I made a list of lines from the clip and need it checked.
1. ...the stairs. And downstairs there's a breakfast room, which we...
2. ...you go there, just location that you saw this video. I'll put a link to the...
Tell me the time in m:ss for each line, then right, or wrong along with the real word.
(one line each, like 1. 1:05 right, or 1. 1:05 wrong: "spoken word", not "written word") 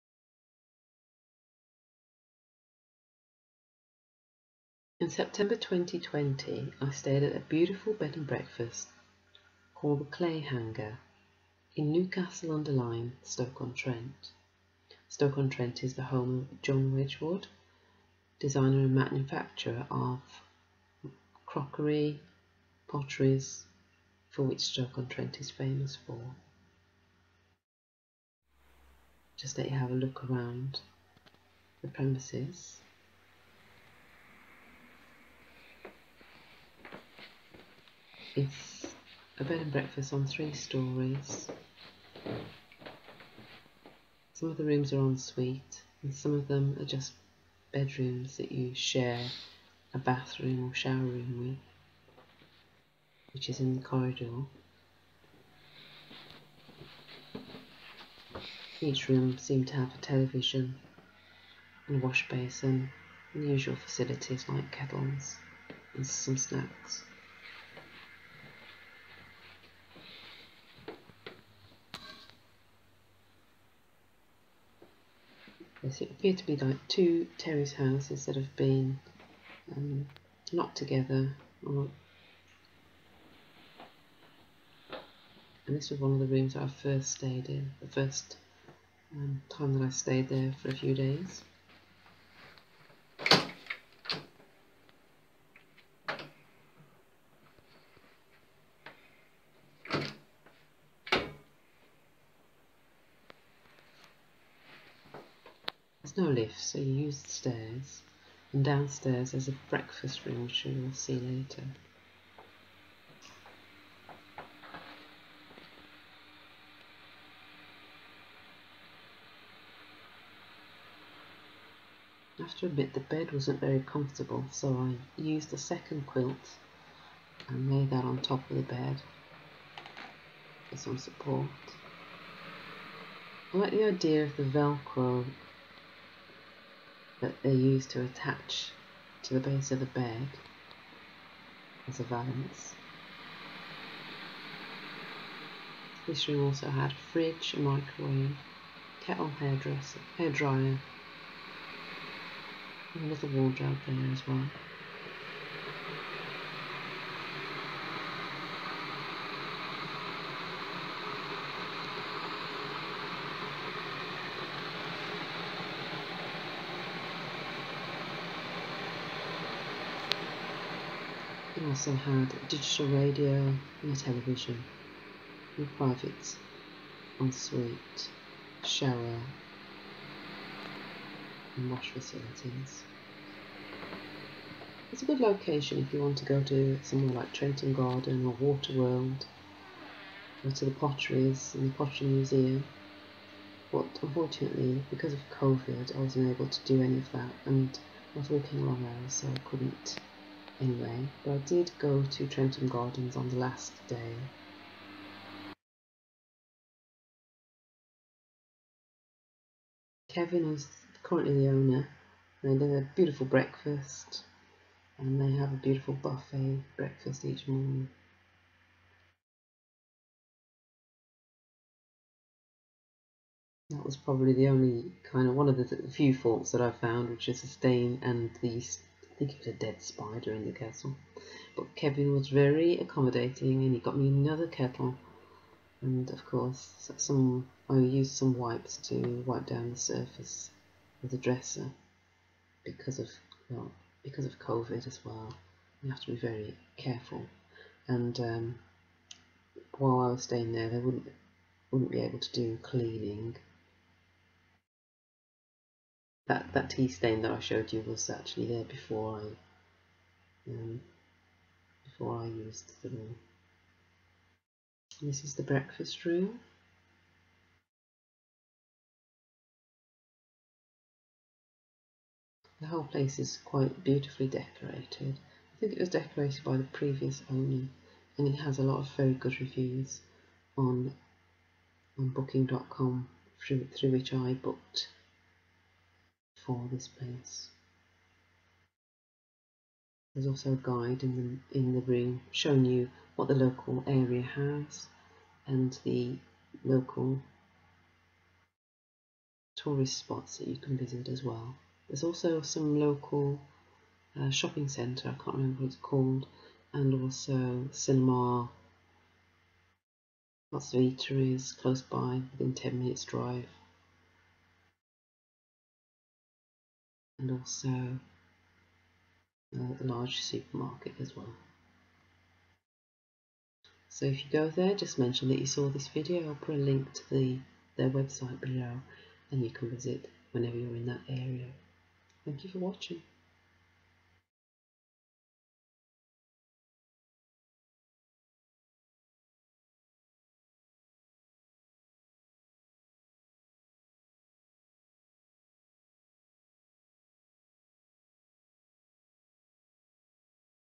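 1. 1:47 right
2. 5:24 wrong: "mention", not "location".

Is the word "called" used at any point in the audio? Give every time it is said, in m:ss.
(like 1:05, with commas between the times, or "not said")
0:09, 5:05.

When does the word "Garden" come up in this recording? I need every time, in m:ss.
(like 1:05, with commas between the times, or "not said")
3:07, 3:22.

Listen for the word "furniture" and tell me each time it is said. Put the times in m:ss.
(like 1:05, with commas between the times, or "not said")
not said.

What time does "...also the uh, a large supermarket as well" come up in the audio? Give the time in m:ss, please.
5:17.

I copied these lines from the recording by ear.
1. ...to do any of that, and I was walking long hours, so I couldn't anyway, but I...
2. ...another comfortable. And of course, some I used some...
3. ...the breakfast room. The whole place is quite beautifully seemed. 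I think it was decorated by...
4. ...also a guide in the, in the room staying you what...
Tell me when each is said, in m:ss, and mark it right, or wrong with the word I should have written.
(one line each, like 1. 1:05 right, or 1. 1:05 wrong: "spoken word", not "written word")
1. 3:16 right
2. 3:54 wrong: "kettle", not "comfortable"
3. 4:25 wrong: "decorated", not "seemed"
4. 4:50 wrong: "showing", not "staying".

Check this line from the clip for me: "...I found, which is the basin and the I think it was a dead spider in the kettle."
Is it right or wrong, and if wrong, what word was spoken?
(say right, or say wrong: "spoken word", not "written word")
wrong: "stain", not "basin".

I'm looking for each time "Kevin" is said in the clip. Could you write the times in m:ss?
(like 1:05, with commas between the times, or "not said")
3:30, 3:51.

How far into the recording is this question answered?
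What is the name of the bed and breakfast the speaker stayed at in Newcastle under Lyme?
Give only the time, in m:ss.
0:10.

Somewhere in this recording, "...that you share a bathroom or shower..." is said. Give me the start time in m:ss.
0:48.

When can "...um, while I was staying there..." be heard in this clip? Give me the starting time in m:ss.
4:08.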